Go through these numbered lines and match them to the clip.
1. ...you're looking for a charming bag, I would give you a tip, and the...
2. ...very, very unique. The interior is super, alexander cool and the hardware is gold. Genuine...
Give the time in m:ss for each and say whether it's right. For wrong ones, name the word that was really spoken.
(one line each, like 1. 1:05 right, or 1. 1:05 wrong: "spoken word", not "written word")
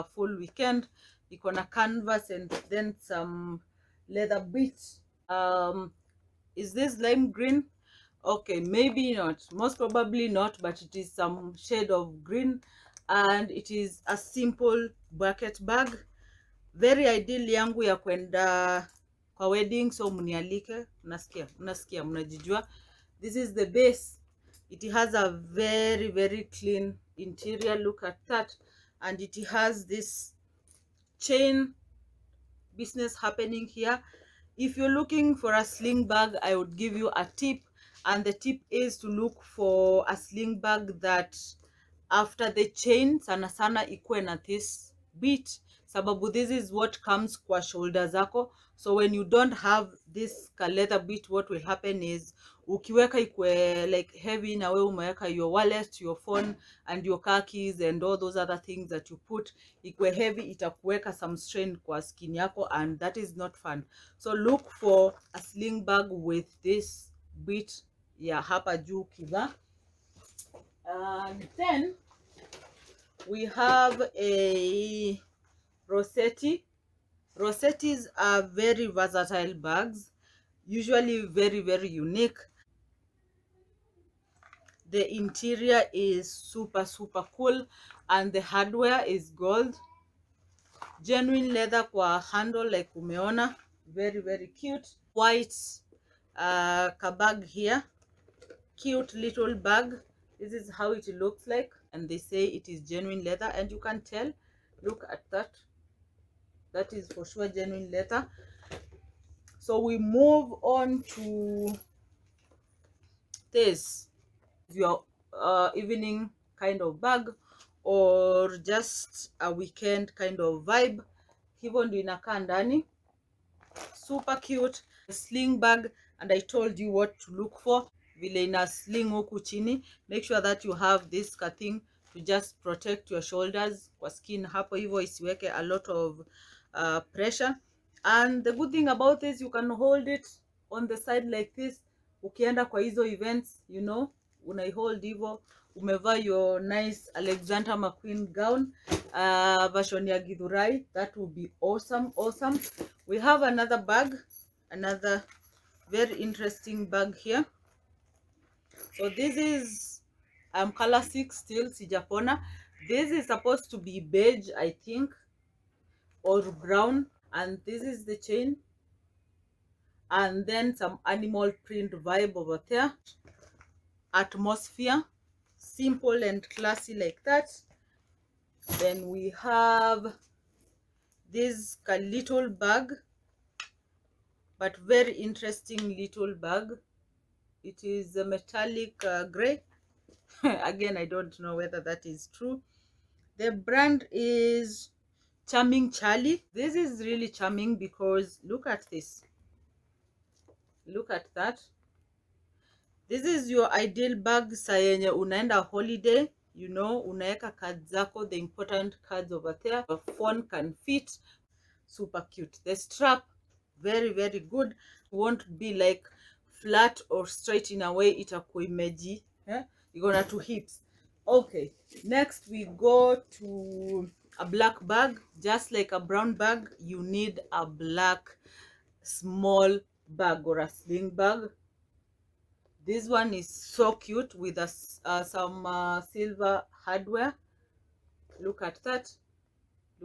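1. 0:34 wrong: "sling", not "charming"
2. 1:21 wrong: "super", not "alexander".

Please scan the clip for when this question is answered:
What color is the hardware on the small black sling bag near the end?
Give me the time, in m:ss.
3:56.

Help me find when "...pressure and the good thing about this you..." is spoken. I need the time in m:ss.
2:17.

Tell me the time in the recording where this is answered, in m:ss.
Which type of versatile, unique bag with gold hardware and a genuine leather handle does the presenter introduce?
1:15.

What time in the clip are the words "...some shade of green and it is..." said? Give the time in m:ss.
0:11.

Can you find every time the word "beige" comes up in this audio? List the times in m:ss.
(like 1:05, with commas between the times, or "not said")
2:44.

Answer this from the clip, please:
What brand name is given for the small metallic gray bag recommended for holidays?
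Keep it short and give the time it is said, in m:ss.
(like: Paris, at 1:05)
Charming Charlie, at 3:15.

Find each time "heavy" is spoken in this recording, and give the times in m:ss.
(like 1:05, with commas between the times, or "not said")
0:54, 1:00.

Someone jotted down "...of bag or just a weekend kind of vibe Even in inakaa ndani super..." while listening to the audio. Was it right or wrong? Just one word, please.
right.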